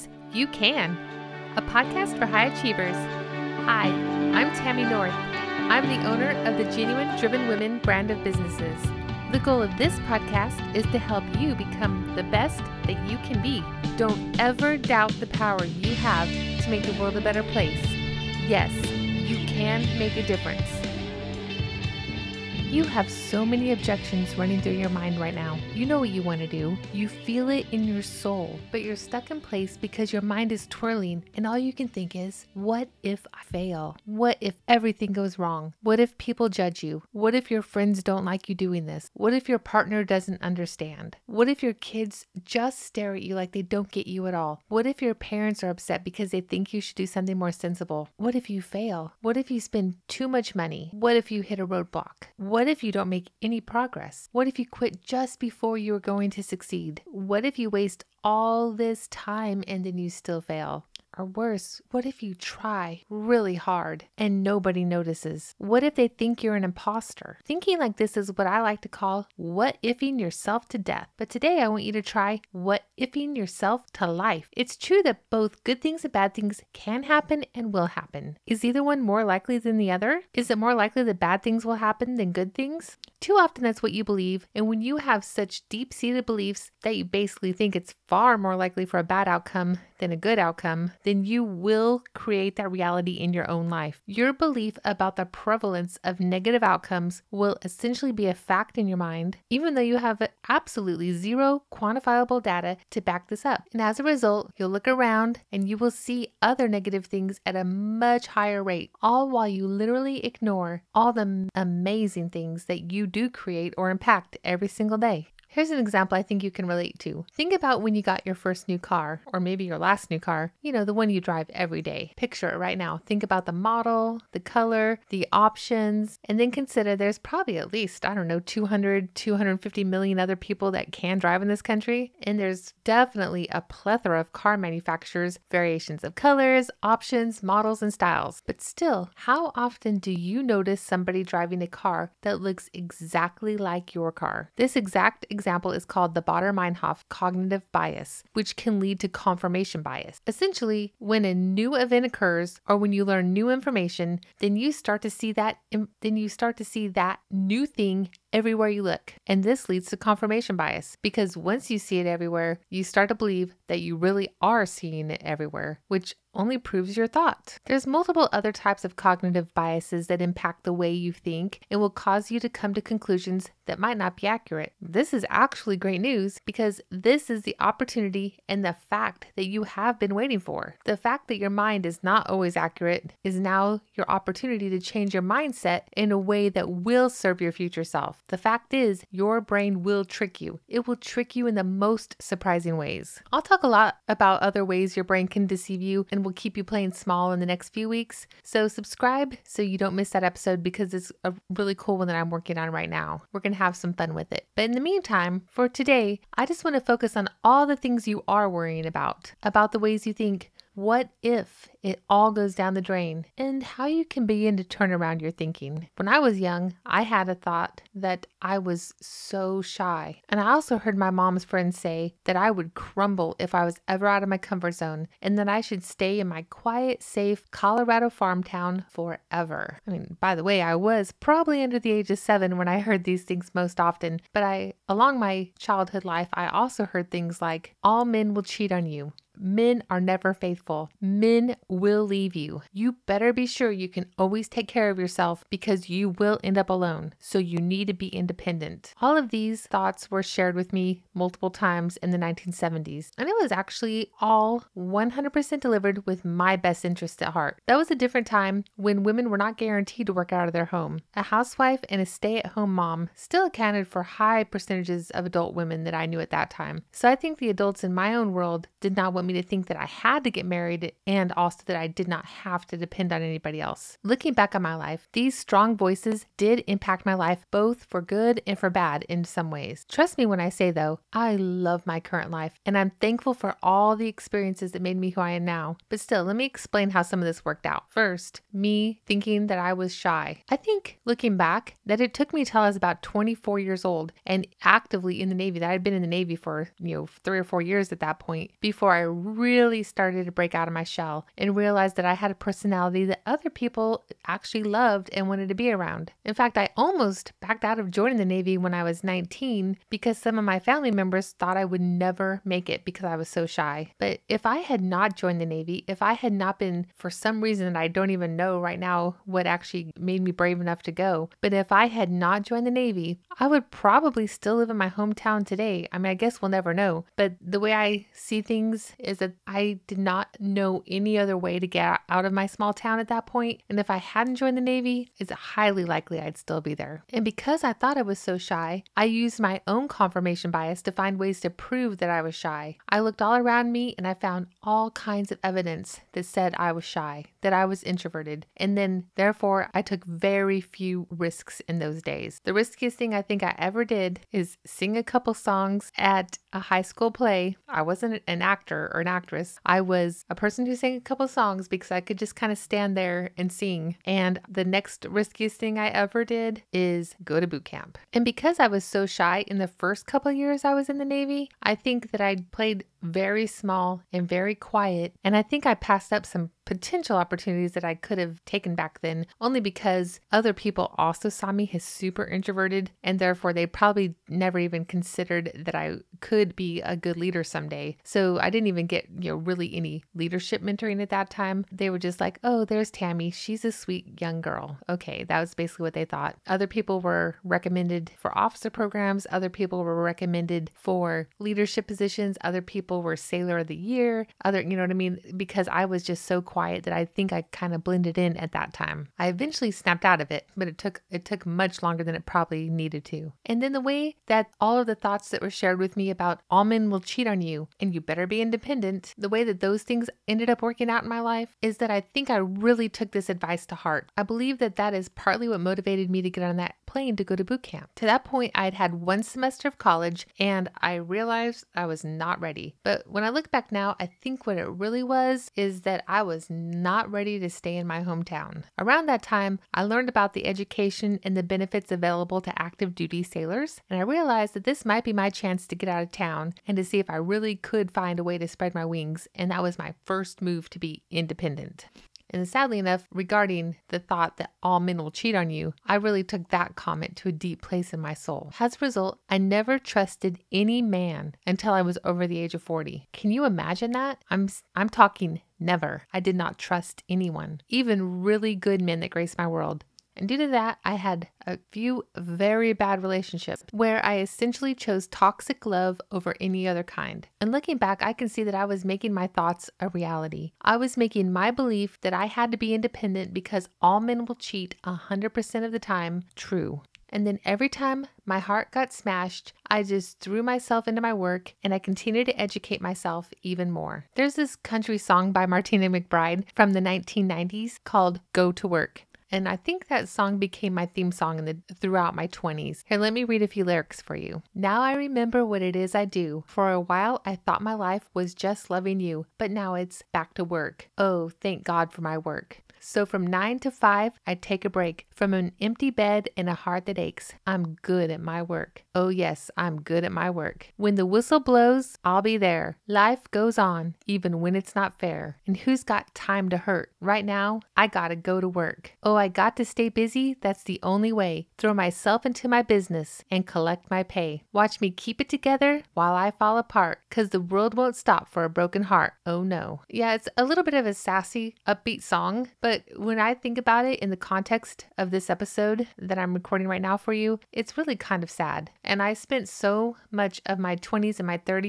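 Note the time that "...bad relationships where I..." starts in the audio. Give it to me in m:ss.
7:52.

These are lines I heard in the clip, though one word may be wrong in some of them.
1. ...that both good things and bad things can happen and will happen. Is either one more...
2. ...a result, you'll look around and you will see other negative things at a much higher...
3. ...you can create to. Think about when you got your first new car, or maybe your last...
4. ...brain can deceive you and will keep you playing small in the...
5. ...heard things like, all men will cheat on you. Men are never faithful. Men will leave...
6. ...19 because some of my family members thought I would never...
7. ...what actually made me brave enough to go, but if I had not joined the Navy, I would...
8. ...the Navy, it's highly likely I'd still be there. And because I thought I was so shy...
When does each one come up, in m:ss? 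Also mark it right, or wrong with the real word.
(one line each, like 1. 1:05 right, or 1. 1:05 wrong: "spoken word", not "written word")
1. 1:15 right
2. 1:44 right
3. 1:56 wrong: "relate", not "create"
4. 3:15 right
5. 3:56 right
6. 5:09 right
7. 5:19 right
8. 5:34 right.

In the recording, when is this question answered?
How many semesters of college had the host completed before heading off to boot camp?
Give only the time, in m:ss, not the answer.
7:08.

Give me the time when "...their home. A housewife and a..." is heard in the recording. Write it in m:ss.
4:20.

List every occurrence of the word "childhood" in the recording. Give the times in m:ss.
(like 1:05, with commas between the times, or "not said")
3:55.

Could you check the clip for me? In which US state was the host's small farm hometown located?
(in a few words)
Colorado.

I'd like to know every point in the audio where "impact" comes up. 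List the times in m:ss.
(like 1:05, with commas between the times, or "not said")
1:53, 2:50, 4:36.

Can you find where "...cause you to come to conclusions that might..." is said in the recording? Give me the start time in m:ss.
2:51.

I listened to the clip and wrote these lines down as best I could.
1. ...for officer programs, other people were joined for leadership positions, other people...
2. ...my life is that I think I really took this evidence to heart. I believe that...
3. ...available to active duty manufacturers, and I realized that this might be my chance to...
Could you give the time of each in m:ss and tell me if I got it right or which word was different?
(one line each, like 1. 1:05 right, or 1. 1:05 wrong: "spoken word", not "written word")
1. 6:38 wrong: "recommended", not "joined"
2. 7:01 wrong: "advice", not "evidence"
3. 7:21 wrong: "sailors", not "manufacturers".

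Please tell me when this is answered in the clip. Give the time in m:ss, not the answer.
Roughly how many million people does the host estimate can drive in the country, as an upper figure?
2:09.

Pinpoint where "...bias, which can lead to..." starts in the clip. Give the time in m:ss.
2:27.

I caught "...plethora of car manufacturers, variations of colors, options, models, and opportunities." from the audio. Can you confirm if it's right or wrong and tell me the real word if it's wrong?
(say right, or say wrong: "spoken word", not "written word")
wrong: "styles", not "opportunities".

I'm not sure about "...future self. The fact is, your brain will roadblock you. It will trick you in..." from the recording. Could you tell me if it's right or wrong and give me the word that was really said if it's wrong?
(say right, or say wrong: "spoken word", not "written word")
wrong: "trick", not "roadblock".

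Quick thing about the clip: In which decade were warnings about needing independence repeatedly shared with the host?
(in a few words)
1970s.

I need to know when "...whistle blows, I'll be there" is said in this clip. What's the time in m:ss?
8:41.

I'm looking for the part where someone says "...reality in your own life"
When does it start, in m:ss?
1:32.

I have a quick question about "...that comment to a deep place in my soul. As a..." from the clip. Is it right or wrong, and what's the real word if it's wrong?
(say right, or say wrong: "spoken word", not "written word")
right.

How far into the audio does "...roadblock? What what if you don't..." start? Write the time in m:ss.
0:51.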